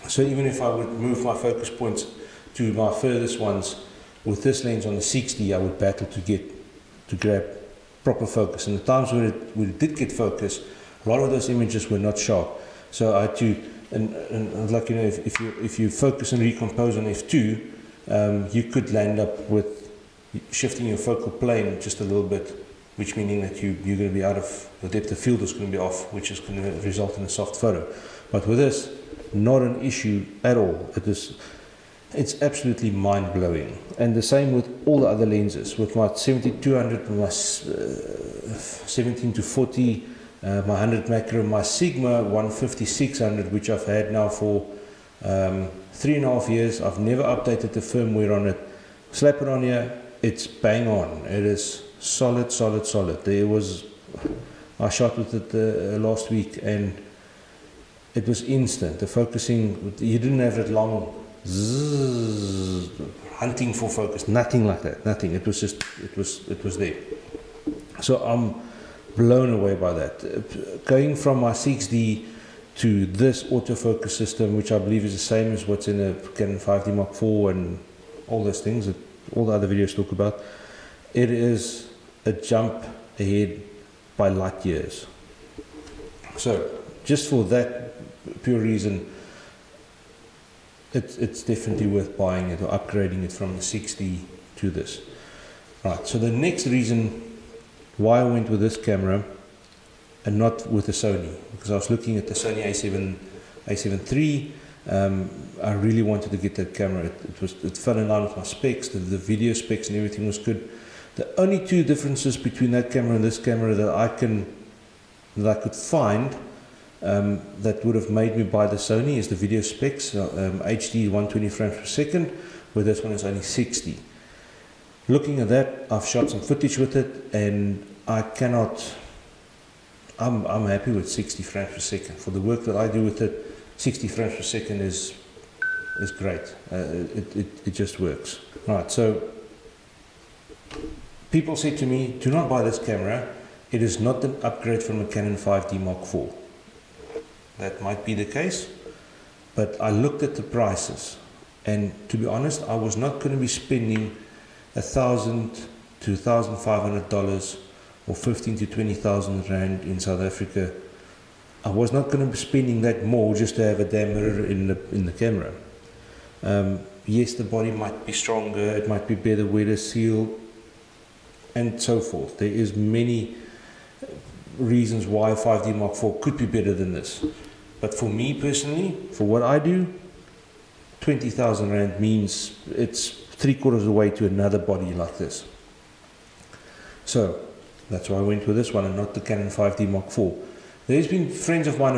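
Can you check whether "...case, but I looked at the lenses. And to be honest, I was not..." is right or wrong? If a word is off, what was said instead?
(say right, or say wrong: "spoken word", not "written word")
wrong: "prices", not "lenses".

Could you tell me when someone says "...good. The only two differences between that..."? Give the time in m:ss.
1:50.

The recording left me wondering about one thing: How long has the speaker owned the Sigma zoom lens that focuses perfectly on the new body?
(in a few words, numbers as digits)
3.5 years.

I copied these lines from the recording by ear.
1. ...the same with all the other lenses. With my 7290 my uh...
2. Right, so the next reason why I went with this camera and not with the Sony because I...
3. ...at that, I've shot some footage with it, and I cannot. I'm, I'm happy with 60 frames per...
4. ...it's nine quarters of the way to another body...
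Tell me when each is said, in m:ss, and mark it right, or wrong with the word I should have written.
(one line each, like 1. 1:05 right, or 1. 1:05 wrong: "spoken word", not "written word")
1. 0:34 wrong: "7200", not "7290"
2. 1:35 right
3. 2:05 right
4. 3:02 wrong: "three", not "nine".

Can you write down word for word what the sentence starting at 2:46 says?
Um, yes, the body might be stronger, it might be better weather seal, and so forth.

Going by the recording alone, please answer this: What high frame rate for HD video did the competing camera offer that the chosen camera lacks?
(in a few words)
120 frames per second.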